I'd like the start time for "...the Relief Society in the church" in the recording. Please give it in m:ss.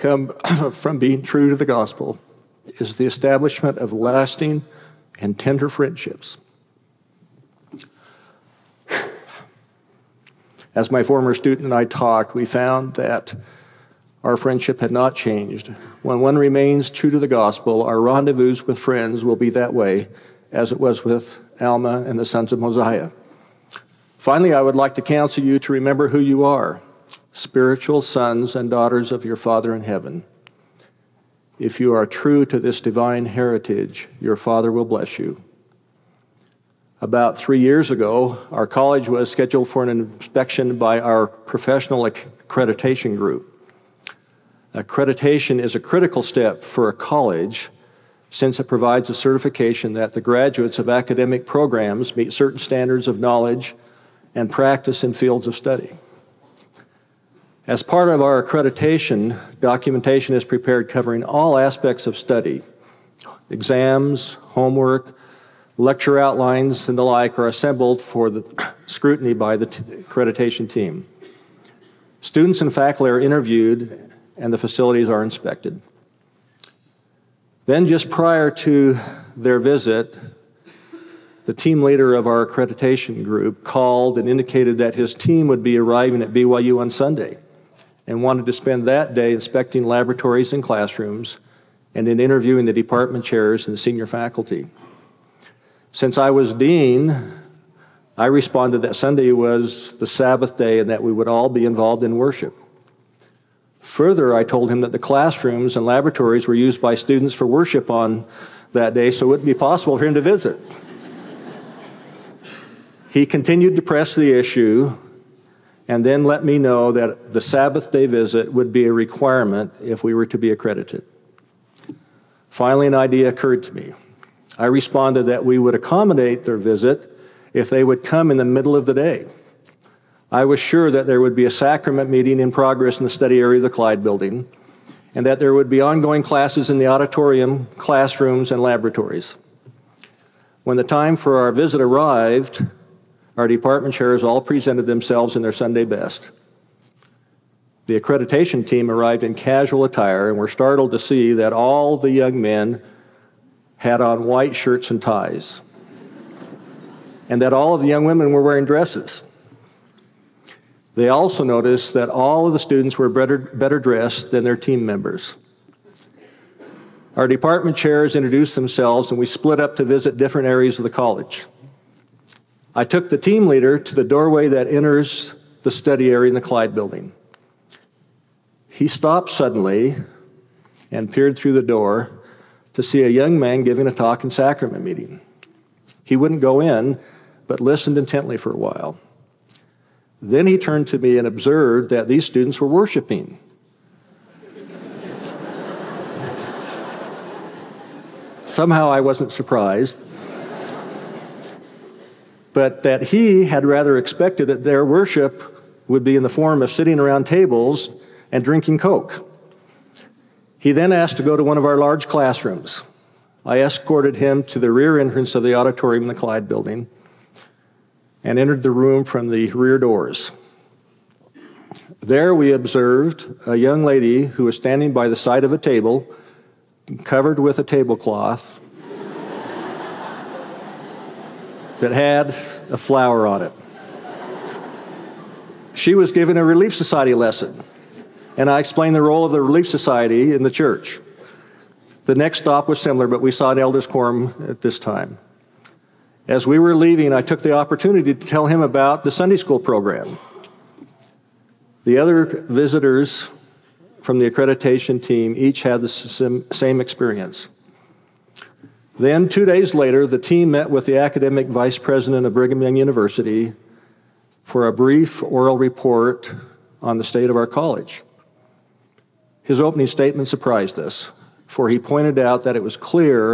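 3:59.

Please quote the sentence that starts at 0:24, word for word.
Finally, I would like to counsel you to remember who you are spiritual sons and daughters of your Father in heaven.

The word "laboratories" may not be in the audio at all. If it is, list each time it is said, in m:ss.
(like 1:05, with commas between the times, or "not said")
1:29, 1:45, 2:18.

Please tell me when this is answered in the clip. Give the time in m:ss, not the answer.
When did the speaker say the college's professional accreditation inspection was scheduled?
0:36.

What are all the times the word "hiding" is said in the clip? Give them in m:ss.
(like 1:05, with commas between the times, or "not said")
not said.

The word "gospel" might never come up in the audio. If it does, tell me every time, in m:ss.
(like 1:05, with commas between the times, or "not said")
0:01, 0:17.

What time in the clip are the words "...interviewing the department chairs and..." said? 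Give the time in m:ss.
1:32.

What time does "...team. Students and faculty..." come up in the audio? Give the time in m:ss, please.
1:10.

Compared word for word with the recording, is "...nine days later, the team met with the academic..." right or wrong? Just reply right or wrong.
wrong.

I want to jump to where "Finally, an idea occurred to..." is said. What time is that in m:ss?
2:02.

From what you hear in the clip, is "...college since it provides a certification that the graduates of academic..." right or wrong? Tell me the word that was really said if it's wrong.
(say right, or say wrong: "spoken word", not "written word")
right.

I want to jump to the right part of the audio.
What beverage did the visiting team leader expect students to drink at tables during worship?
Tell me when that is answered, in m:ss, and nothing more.
3:28.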